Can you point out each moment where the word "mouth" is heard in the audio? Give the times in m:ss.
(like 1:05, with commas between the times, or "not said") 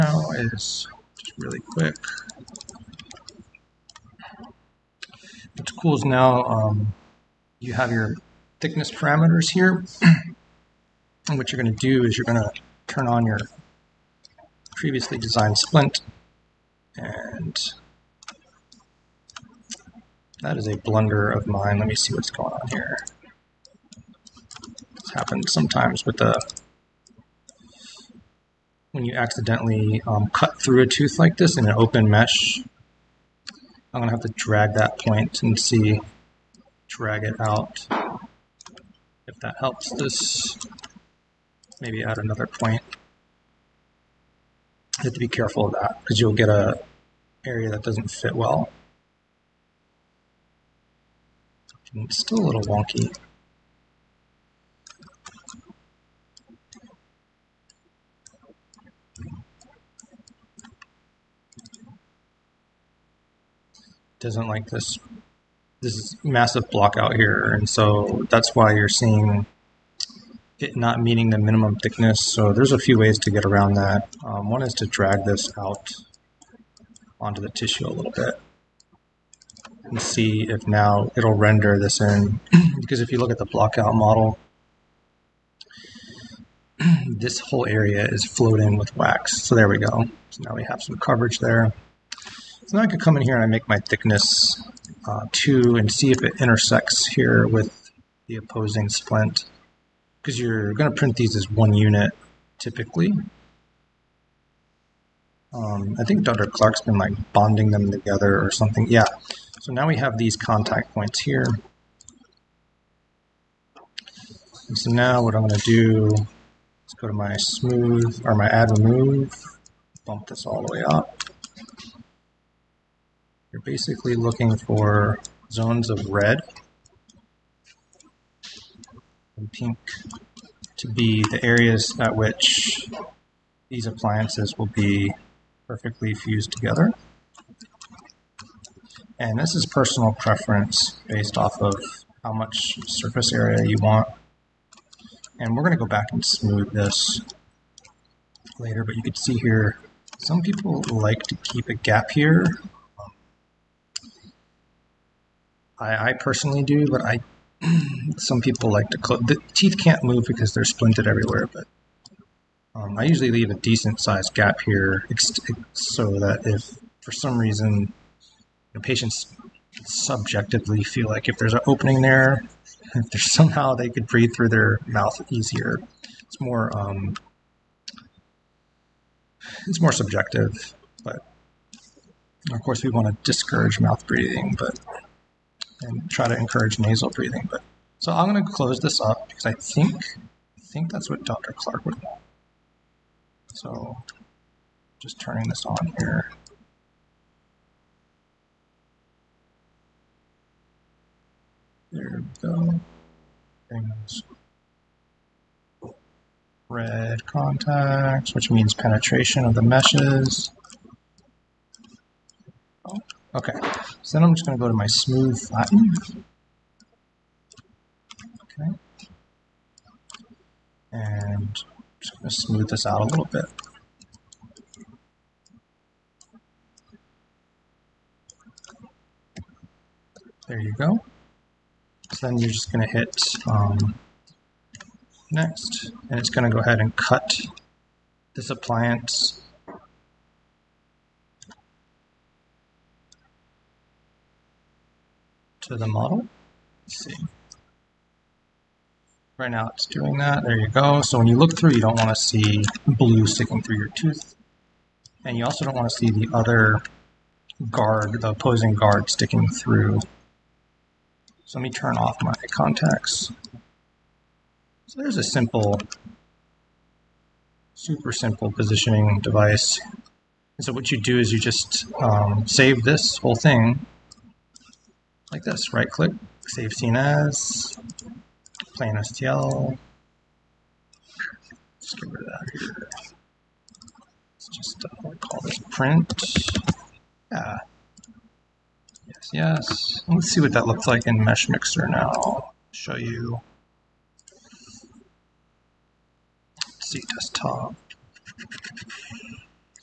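2:54, 3:03.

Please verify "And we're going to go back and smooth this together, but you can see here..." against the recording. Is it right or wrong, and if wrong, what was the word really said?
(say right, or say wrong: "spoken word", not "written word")
wrong: "later", not "together".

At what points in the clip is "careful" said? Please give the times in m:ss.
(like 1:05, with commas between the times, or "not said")
0:45.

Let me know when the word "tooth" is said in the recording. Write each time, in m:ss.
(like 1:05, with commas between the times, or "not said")
0:30, 4:13.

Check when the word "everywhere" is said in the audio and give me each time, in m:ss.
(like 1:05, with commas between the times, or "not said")
2:41.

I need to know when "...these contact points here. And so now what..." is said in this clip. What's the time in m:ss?
1:50.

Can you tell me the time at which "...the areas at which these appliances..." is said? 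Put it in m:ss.
2:11.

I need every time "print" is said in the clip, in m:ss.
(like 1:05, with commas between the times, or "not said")
1:40, 4:45.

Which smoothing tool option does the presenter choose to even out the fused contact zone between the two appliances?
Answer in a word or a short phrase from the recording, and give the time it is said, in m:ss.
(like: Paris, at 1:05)
smooth flatten, at 3:34.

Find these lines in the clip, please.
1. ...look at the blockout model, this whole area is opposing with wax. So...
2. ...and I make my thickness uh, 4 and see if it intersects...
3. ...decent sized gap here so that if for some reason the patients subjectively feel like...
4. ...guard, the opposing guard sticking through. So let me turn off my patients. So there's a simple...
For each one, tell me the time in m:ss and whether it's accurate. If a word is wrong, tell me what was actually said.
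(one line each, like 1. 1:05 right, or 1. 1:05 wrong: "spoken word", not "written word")
1. 1:23 wrong: "floating", not "opposing"
2. 1:33 wrong: "2", not "4"
3. 2:43 right
4. 4:17 wrong: "contacts", not "patients".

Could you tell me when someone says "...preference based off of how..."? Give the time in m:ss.
2:20.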